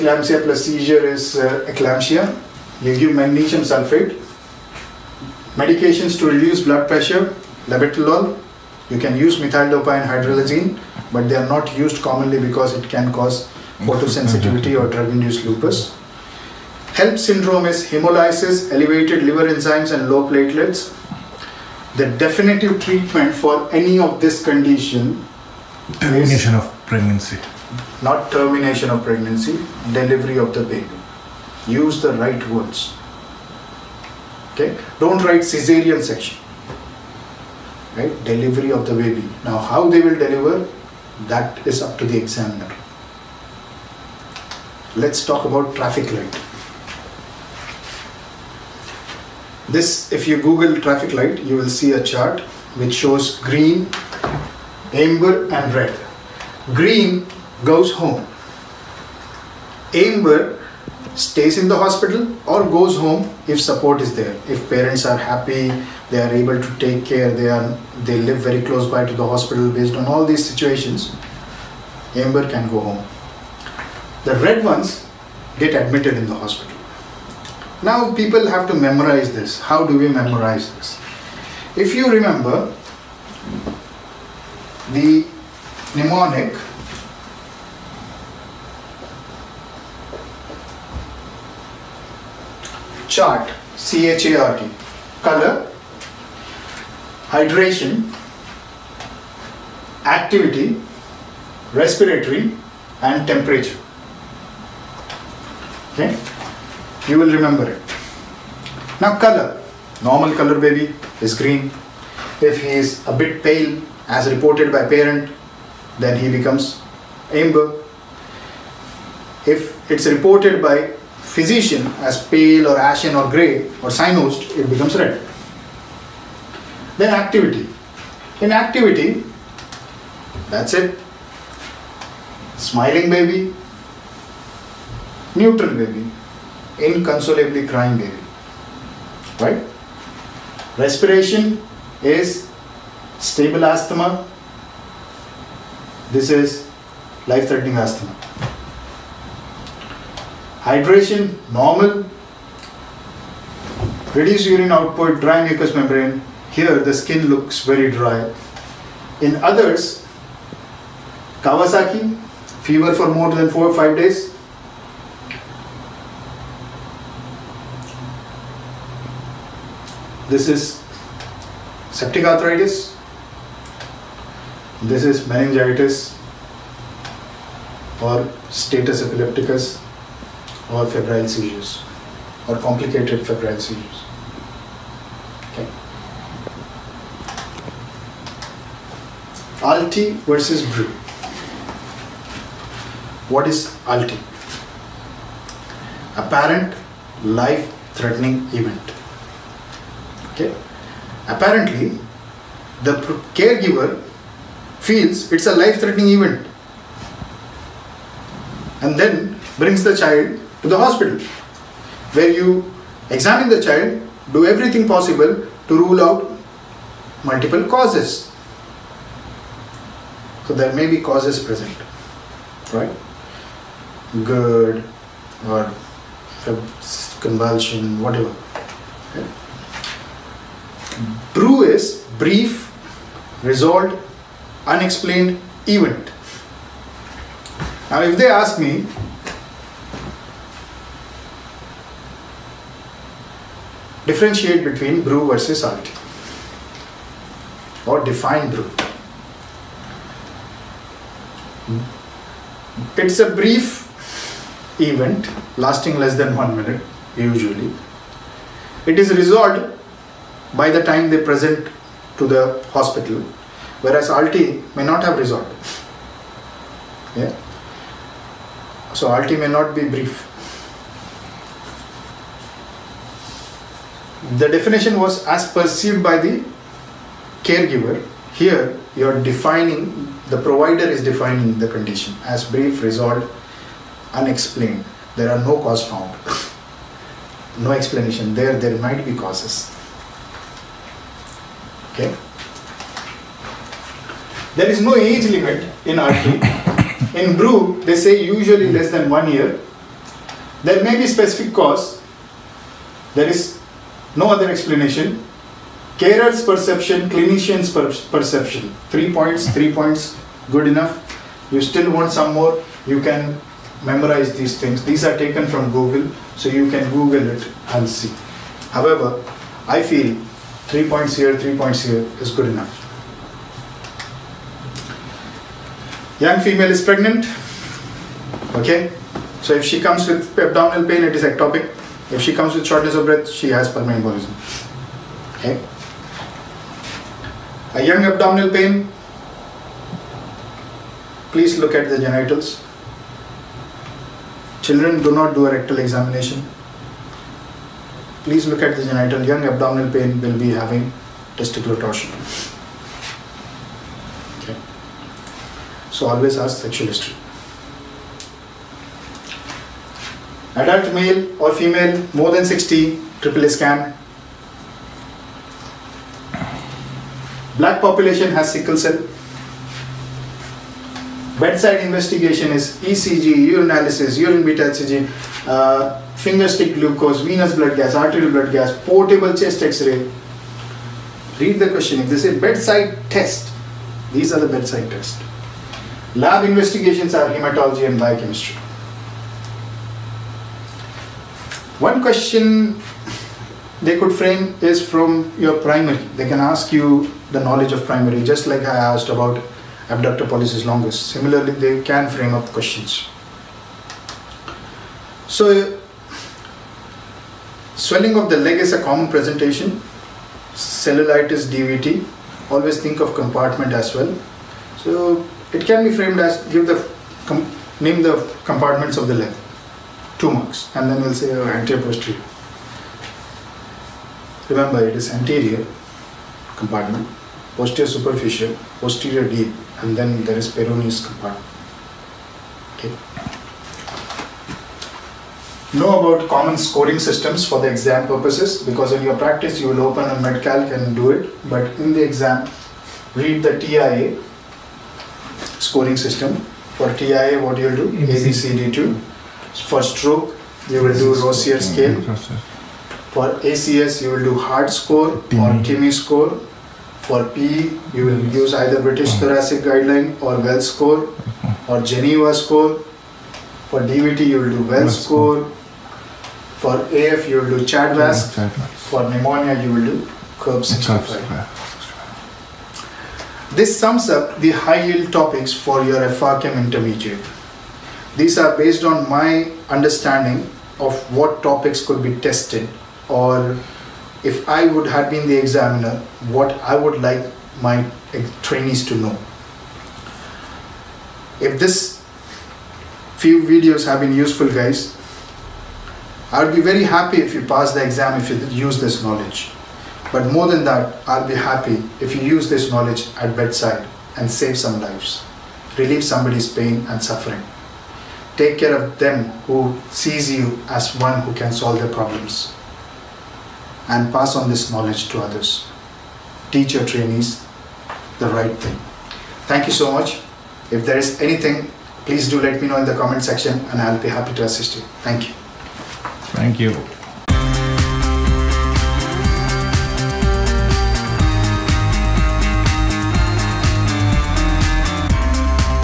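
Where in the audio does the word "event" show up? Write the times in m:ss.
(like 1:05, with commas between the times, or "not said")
3:18, 3:26, 3:55, 4:14.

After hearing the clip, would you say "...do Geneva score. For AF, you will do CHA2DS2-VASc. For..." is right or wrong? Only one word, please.
wrong.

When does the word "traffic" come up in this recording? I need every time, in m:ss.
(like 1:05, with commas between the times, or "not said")
0:45, 0:50.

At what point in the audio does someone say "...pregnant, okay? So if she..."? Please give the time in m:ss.
5:26.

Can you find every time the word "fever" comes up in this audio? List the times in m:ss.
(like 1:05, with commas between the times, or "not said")
2:42.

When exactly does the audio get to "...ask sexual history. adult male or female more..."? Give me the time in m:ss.
5:56.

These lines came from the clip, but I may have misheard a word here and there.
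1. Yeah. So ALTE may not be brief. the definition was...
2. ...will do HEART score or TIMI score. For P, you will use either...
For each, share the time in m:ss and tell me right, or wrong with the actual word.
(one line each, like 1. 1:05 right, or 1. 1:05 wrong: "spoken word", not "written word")
1. 4:27 right
2. 7:34 right.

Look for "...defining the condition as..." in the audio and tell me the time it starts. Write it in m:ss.
4:41.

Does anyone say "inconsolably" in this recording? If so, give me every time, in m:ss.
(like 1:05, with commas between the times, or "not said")
2:16.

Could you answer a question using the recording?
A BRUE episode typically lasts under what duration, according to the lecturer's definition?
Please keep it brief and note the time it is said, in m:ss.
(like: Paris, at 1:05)
One minute, at 4:15.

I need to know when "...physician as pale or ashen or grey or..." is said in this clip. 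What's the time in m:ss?
2:01.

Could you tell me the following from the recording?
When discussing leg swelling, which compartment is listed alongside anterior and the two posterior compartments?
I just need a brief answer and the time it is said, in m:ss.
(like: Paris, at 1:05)
Peroneus compartment, at 7:10.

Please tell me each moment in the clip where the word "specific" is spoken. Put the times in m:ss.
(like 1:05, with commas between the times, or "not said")
5:01.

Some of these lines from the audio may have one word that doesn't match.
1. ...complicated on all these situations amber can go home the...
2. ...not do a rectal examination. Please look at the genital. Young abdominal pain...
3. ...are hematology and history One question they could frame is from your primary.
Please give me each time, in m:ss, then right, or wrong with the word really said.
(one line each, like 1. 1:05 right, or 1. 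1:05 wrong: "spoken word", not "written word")
1. 1:09 wrong: "based", not "complicated"
2. 5:45 right
3. 6:27 wrong: "biochemistry", not "history".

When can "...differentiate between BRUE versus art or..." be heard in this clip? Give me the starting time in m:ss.
4:04.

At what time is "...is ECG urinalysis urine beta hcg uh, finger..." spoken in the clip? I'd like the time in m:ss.
6:12.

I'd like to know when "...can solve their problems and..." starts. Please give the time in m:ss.
8:31.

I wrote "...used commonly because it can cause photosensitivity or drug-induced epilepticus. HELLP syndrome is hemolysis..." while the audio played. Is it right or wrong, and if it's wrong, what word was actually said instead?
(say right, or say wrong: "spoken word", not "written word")
wrong: "lupus", not "epilepticus".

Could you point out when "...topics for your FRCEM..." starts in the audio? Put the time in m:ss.
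7:55.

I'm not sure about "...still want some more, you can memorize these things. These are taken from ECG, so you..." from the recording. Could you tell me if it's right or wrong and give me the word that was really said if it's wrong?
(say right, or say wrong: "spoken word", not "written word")
wrong: "Google", not "ECG".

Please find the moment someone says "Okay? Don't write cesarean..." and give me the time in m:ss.
0:34.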